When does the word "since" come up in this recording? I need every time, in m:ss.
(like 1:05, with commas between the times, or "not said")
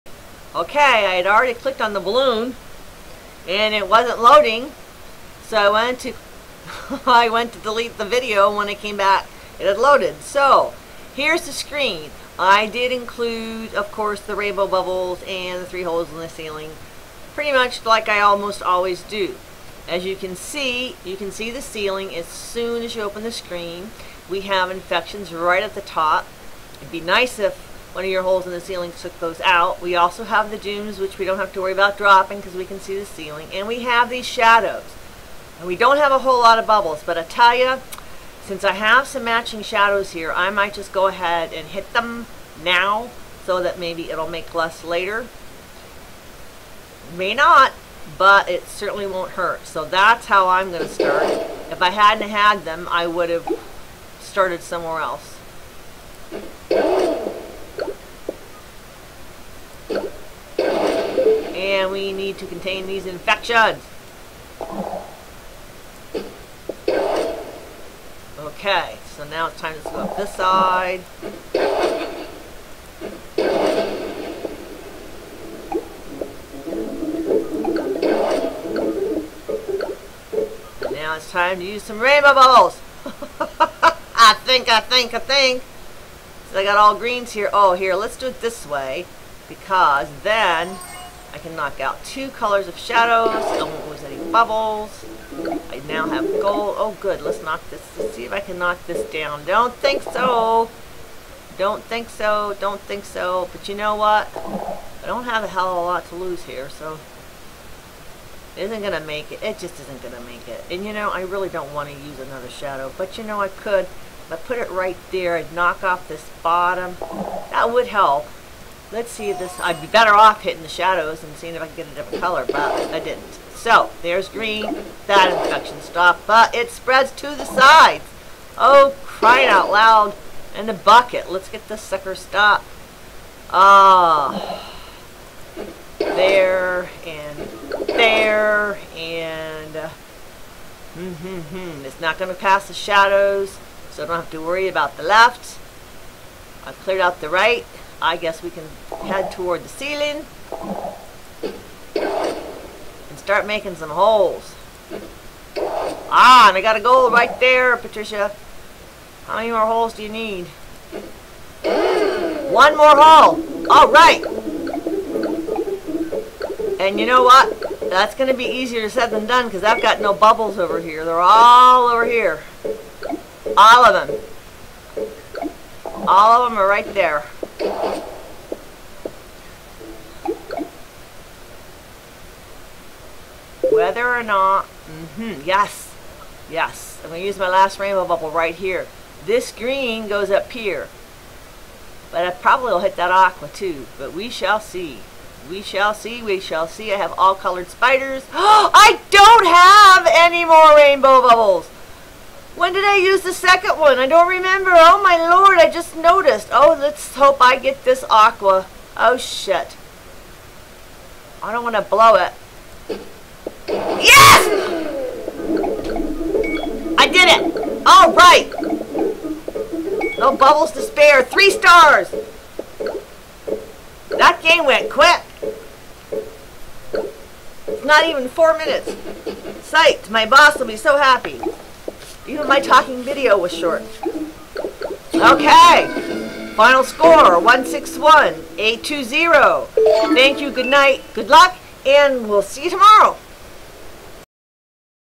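0:38.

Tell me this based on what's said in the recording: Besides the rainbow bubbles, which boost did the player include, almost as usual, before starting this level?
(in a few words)
three holes in the ceiling.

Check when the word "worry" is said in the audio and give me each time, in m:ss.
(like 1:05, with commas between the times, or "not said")
0:31, 2:24.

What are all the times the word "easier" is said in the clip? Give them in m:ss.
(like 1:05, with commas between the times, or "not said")
2:48.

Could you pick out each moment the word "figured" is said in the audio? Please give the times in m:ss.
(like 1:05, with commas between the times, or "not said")
not said.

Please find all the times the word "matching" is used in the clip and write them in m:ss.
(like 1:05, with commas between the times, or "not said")
0:39.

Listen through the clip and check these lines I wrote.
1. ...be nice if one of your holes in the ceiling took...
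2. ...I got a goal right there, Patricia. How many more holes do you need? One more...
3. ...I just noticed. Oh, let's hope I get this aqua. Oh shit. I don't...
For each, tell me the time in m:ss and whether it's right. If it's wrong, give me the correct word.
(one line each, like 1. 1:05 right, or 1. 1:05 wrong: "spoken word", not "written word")
1. 0:26 right
2. 2:36 right
3. 3:25 right.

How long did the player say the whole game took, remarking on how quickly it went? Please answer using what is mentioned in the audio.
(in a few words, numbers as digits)
not even 4 minutes.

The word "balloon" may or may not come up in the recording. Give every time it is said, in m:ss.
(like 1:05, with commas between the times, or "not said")
0:02.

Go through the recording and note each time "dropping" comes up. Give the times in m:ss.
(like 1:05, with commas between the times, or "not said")
0:31.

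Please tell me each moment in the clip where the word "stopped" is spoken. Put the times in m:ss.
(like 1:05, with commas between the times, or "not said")
2:05, 2:12.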